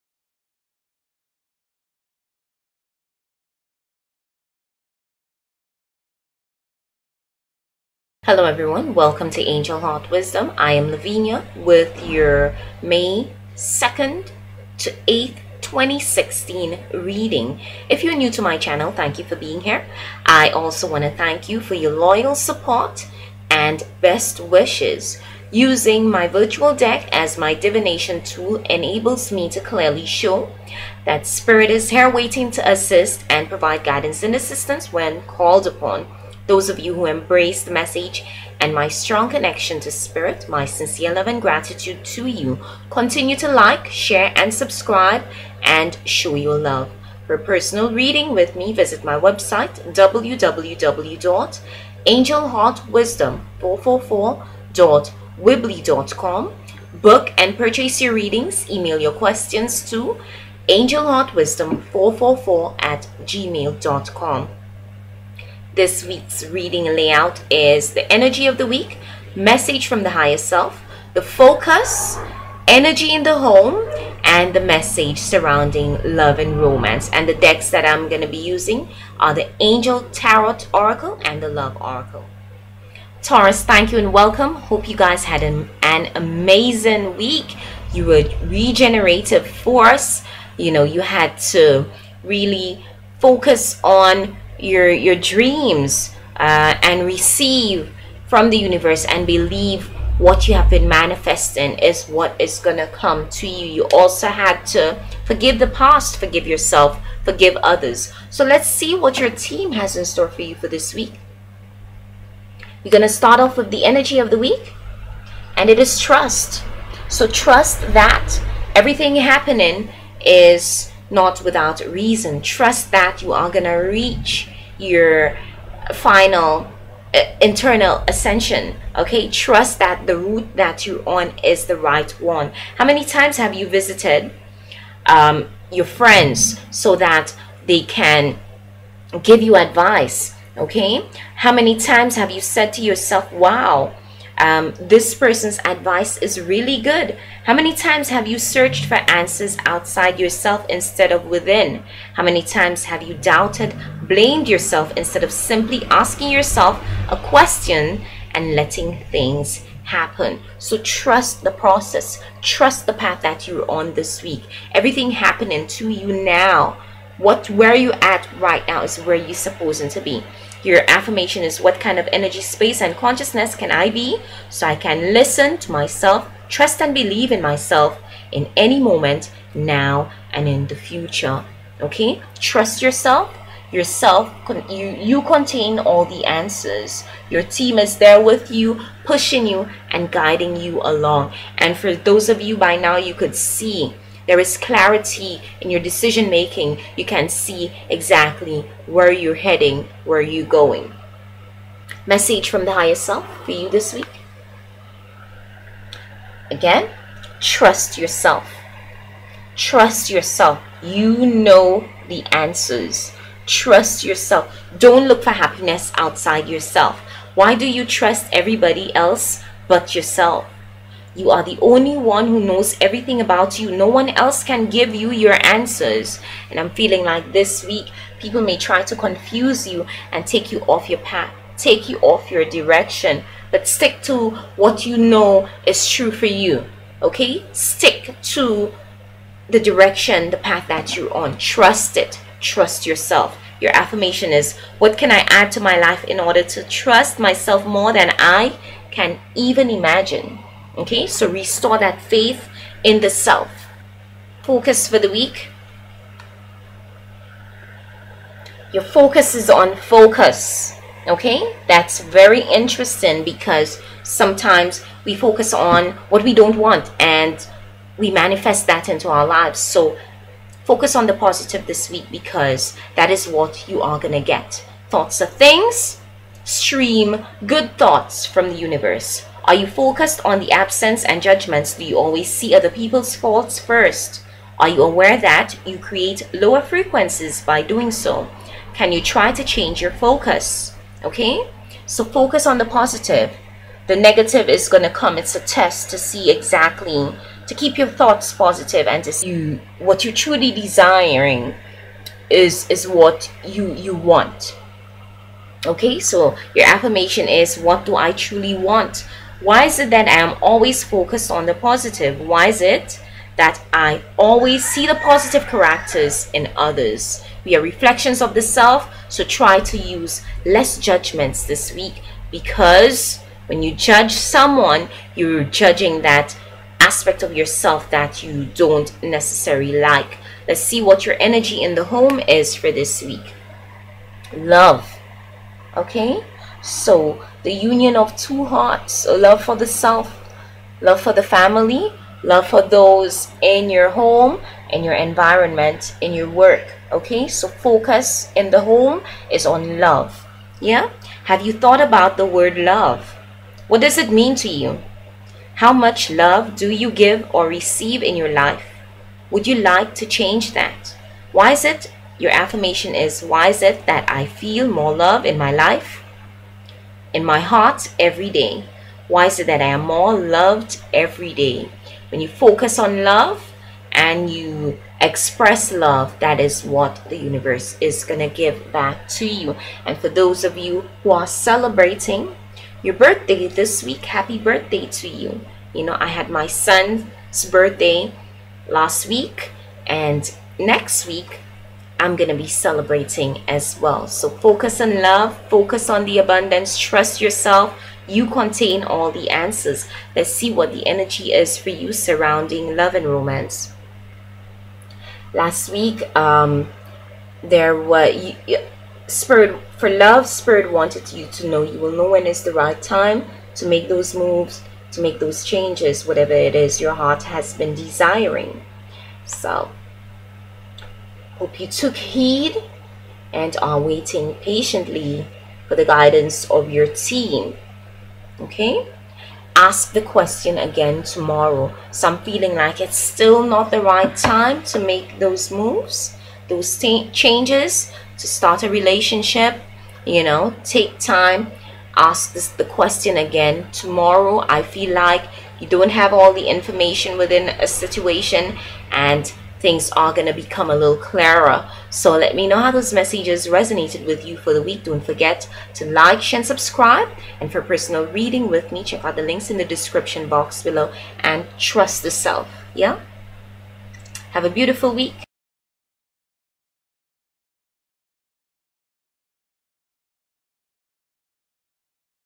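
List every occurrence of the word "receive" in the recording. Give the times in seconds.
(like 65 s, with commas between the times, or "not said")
97 s, 357 s.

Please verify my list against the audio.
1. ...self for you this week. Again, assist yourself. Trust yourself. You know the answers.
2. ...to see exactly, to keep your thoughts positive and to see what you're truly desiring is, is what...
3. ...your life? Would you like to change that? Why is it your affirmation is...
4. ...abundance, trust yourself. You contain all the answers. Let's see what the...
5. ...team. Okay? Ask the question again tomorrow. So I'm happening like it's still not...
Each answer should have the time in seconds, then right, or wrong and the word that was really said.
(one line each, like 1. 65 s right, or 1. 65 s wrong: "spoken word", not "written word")
1. 202 s wrong: "trust", not "assist"
2. 295 s right
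3. 358 s right
4. 396 s right
5. 426 s wrong: "feeling", not "happening".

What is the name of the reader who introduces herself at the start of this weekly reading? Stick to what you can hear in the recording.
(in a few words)
Lavinia.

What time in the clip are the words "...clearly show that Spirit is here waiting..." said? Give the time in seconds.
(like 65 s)
29 s.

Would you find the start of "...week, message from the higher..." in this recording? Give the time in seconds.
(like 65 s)
68 s.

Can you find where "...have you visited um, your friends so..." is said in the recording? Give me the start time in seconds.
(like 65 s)
133 s.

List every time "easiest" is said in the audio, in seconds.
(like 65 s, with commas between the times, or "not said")
not said.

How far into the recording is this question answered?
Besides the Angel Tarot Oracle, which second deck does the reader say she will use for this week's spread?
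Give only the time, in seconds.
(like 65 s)
81 s.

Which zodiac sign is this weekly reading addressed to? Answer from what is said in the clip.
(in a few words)
Taurus.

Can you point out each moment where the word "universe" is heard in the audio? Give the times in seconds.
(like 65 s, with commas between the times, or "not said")
98 s, 278 s, 377 s.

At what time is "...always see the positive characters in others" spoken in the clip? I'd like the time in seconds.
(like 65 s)
314 s.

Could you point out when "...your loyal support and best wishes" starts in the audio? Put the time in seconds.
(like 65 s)
21 s.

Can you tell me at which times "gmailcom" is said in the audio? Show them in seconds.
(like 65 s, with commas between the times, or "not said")
63 s.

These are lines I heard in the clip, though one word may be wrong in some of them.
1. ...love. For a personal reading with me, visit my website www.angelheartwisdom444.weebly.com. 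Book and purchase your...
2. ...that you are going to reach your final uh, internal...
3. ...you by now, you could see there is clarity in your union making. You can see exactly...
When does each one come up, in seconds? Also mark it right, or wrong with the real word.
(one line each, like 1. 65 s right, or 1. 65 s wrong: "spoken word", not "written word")
1. 46 s right
2. 122 s right
3. 192 s wrong: "decision", not "union".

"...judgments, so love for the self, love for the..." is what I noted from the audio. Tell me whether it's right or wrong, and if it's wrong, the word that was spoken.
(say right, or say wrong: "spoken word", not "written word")
wrong: "hearts", not "judgments".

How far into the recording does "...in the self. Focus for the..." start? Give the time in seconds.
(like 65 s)
252 s.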